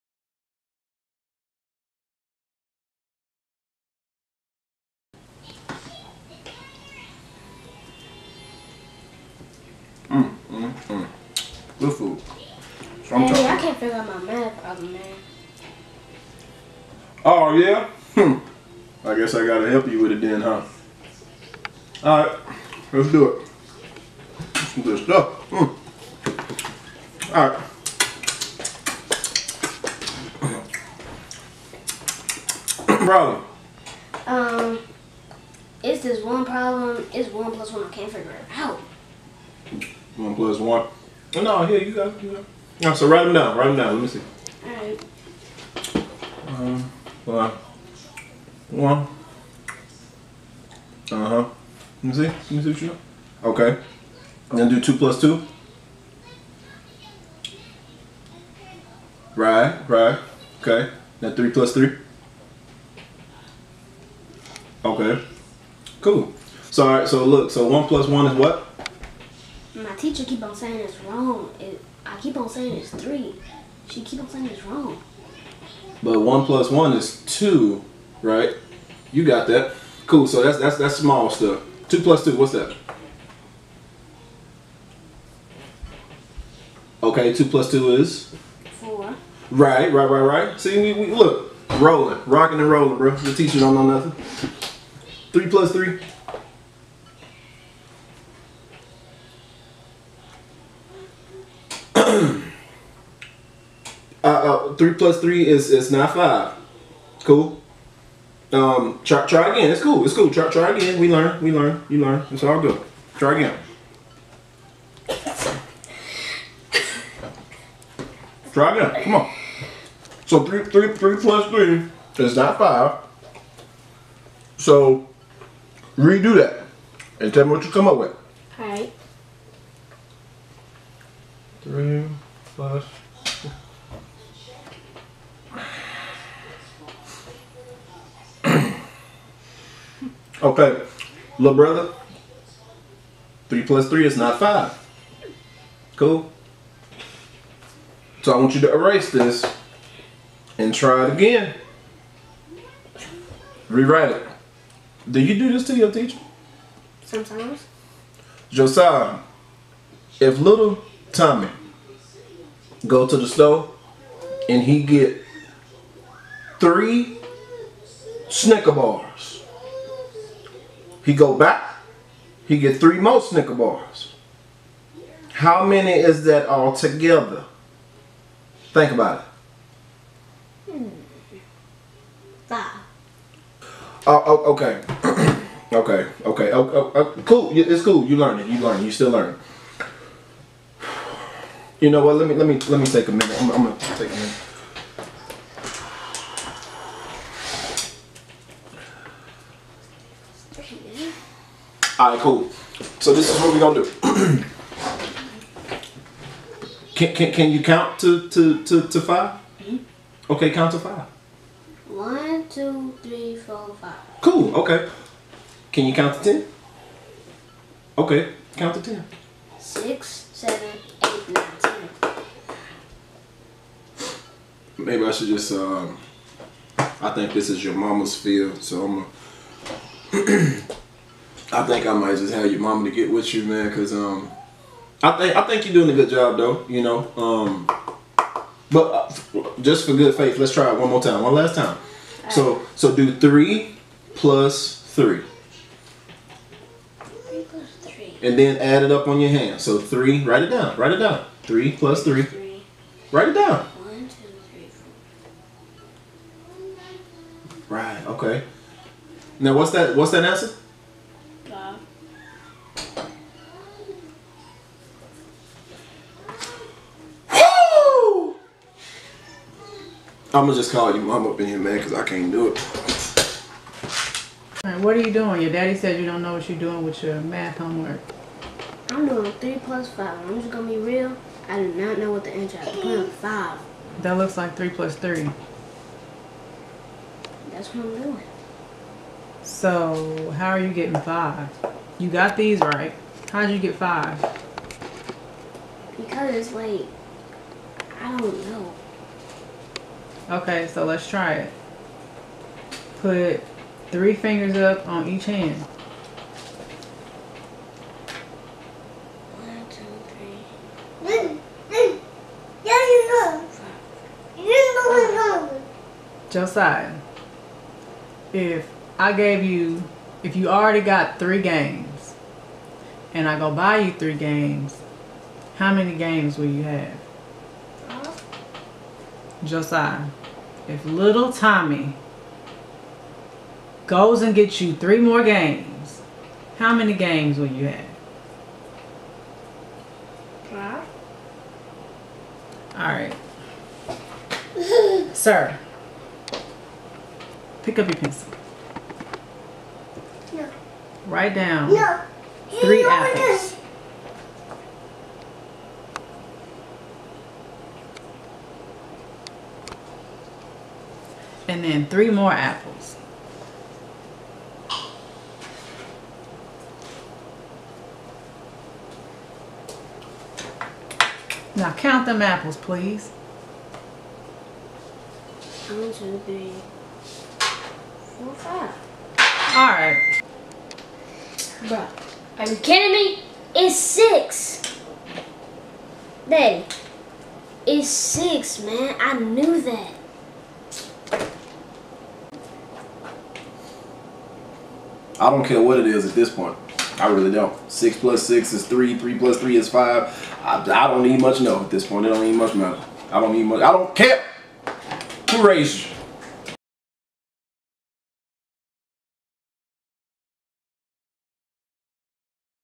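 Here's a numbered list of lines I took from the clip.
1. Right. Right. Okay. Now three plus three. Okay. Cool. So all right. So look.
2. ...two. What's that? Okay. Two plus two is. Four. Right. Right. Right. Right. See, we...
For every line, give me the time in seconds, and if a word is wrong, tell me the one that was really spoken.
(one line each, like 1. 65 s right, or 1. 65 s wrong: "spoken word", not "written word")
1. 59 s right
2. 82 s right.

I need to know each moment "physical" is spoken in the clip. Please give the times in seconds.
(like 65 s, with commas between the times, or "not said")
not said.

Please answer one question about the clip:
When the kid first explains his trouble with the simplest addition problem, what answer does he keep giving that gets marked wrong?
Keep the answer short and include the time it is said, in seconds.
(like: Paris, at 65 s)
3, at 72 s.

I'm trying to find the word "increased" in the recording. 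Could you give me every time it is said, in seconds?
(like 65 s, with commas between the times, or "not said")
not said.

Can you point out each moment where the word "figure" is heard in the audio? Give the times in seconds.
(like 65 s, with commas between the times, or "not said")
13 s, 38 s.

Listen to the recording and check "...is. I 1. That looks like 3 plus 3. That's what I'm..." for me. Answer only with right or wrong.
wrong.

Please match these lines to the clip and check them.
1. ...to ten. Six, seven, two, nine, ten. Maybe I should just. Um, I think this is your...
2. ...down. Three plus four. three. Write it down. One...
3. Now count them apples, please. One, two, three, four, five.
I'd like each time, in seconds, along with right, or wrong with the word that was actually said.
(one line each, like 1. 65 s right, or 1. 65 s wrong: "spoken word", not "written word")
1. 218 s wrong: "eight", not "two"
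2. 250 s wrong: "three", not "four"
3. 371 s right.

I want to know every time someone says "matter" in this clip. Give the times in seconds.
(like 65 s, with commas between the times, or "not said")
402 s.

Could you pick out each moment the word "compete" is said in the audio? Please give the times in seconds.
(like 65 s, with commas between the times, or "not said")
not said.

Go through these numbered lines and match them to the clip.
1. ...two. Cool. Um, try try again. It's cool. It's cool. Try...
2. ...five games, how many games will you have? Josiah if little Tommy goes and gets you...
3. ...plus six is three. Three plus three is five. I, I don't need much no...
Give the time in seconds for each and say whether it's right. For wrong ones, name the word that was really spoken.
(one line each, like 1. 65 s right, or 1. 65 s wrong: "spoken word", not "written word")
1. 106 s wrong: "five", not "two"
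2. 323 s wrong: "three", not "five"
3. 397 s right.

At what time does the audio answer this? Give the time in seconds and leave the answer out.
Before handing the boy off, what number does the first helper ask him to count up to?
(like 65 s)
207 s.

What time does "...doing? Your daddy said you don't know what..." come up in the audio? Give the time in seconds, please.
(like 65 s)
275 s.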